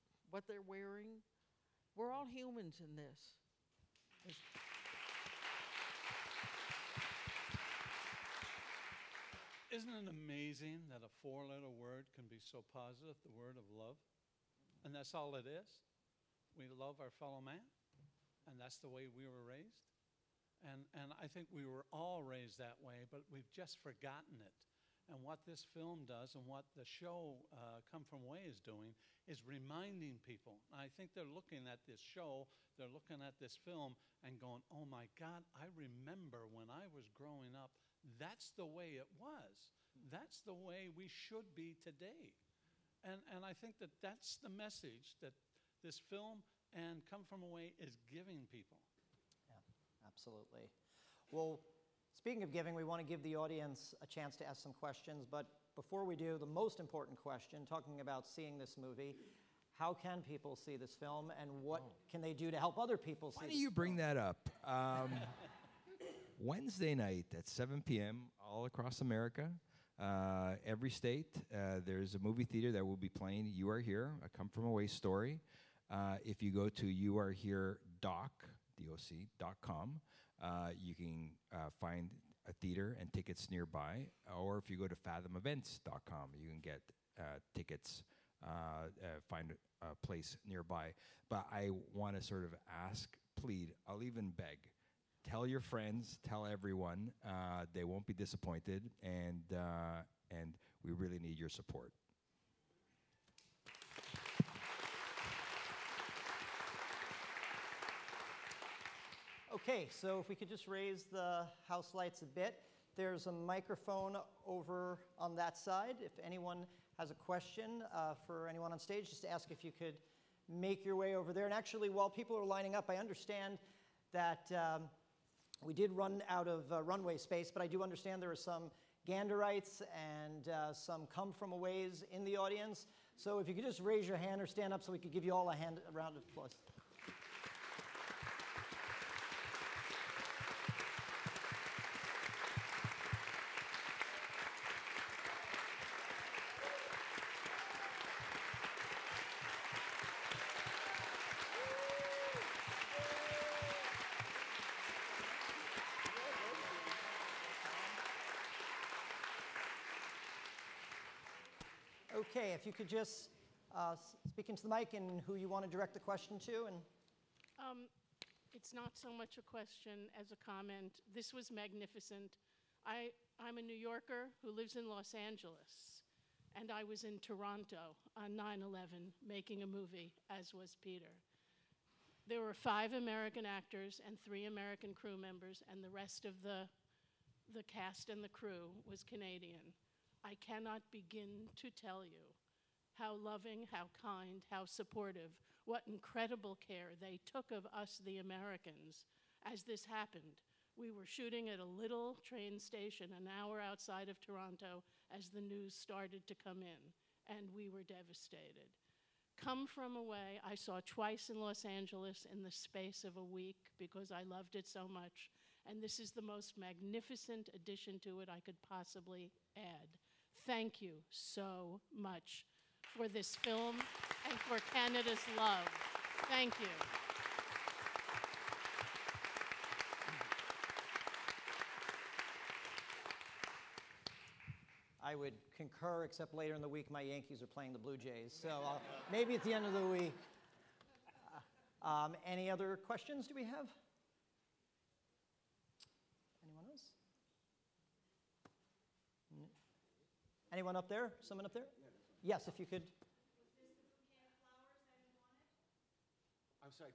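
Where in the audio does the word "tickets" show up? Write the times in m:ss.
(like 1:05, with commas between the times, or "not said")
1:23, 1:27.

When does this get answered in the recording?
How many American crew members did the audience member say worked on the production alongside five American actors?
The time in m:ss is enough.
3:04.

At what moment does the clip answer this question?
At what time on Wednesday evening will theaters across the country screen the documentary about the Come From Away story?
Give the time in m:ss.
1:07.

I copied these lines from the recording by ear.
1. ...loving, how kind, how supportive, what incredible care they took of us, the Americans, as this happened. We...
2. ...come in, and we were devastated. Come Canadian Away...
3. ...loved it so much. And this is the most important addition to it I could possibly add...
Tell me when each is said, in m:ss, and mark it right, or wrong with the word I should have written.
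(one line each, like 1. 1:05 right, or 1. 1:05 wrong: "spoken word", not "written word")
1. 3:13 right
2. 3:26 wrong: "From", not "Canadian"
3. 3:34 wrong: "magnificent", not "important".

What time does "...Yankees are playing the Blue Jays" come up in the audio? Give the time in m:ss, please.
3:57.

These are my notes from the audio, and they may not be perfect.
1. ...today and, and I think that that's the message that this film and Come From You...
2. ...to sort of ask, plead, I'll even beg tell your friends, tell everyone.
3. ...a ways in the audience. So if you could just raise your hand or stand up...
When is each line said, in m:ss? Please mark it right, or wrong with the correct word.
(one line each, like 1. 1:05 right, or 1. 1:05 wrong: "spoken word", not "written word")
1. 0:41 wrong: "Away", not "You"
2. 1:32 right
3. 2:11 right.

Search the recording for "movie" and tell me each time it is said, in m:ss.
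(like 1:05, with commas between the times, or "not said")
0:58, 1:12, 2:59.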